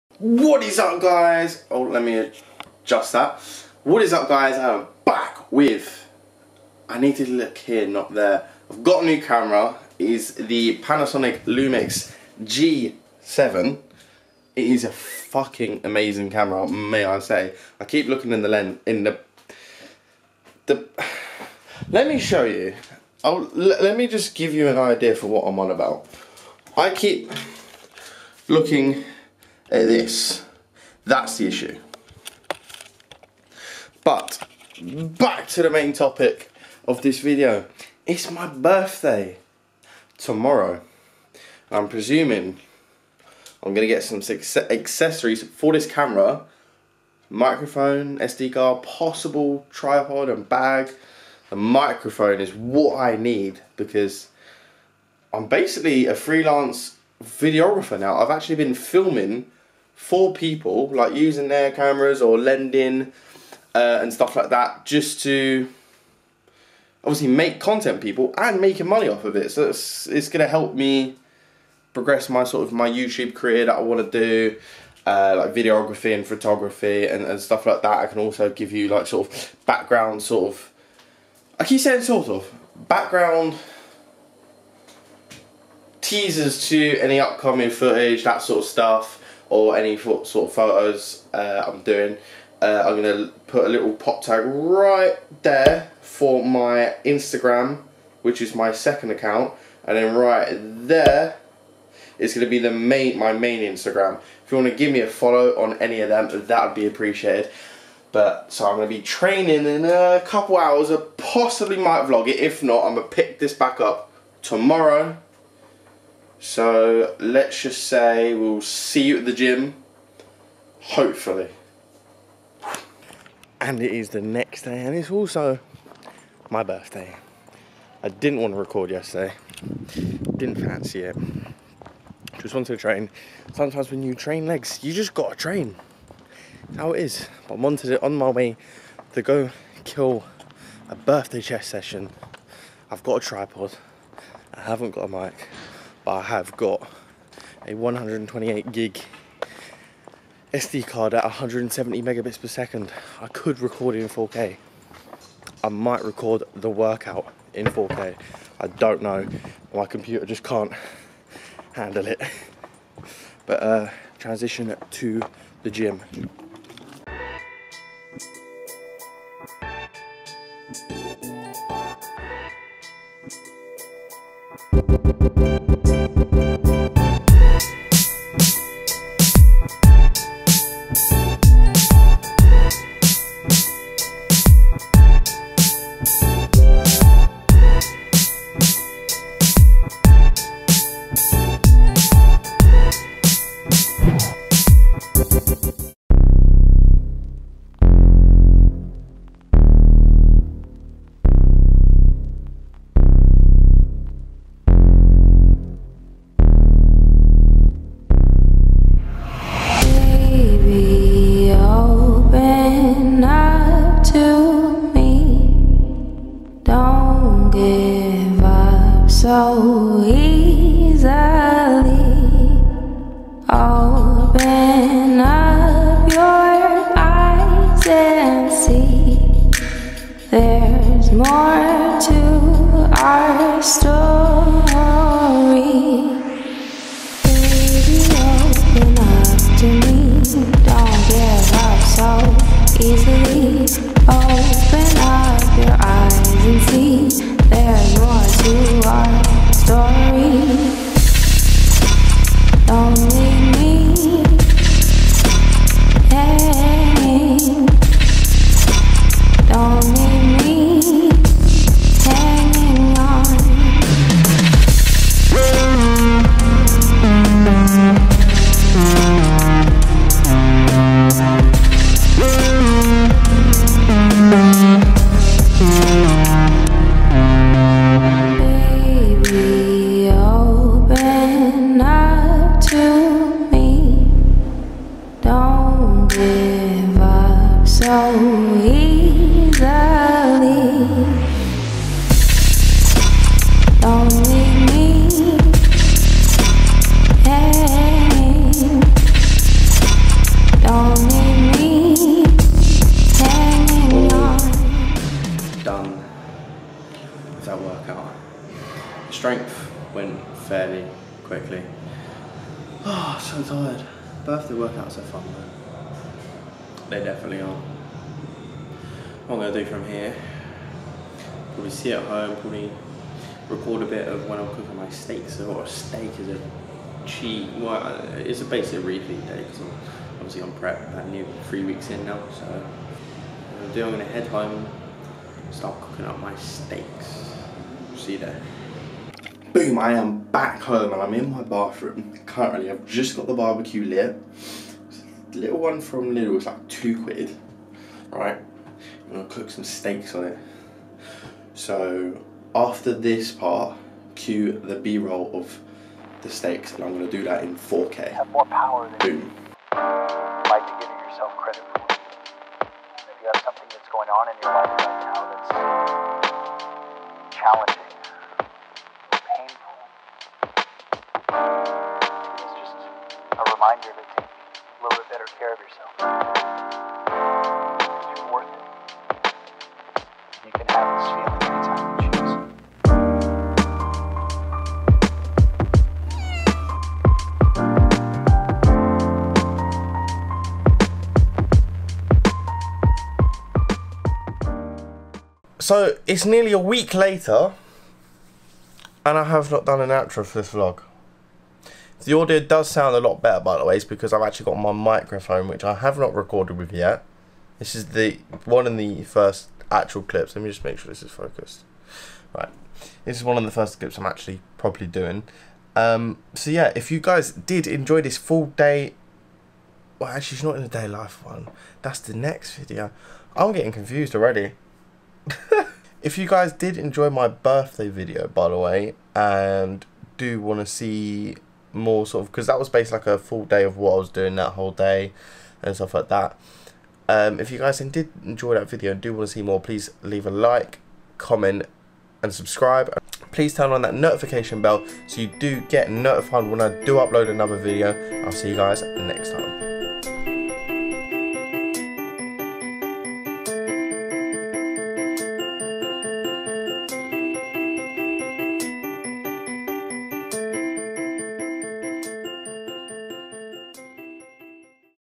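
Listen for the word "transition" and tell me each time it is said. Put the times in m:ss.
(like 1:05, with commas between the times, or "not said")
2:44.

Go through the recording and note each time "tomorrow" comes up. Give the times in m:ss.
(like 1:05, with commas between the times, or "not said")
0:40, 1:54.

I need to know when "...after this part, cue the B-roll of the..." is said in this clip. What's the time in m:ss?
5:52.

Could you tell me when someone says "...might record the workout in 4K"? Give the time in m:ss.
2:35.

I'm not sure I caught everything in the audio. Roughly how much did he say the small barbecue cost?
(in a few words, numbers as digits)
£2.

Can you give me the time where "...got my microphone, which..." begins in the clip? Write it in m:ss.
6:44.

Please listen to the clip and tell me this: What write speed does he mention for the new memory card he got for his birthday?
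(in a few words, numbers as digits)
170 megabits per second.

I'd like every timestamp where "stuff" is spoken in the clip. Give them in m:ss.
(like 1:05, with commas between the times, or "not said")
1:04, 1:17, 1:28, 7:15.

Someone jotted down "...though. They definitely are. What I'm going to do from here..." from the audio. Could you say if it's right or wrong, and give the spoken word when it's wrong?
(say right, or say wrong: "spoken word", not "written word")
right.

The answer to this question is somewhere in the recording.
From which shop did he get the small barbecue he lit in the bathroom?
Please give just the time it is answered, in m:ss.
5:46.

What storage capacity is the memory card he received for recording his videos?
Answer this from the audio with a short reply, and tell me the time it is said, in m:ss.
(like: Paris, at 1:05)
128 gig, at 2:27.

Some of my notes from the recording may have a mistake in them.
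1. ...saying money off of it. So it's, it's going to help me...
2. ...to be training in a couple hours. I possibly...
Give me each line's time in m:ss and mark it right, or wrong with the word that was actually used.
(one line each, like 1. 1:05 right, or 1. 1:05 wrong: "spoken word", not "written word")
1. 1:08 wrong: "making", not "saying"
2. 1:48 right.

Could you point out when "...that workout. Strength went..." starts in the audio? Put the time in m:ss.
5:07.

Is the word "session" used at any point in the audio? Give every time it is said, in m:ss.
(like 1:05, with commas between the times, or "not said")
2:21.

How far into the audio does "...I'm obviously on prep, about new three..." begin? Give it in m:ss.
5:29.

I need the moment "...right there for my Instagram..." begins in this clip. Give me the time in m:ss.
1:34.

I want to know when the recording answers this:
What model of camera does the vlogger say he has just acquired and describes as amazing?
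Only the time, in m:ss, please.
0:10.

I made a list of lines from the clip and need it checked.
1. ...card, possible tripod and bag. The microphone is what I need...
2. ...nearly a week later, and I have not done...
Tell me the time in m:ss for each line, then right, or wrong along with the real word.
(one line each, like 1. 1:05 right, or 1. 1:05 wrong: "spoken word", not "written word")
1. 0:48 right
2. 6:36 right.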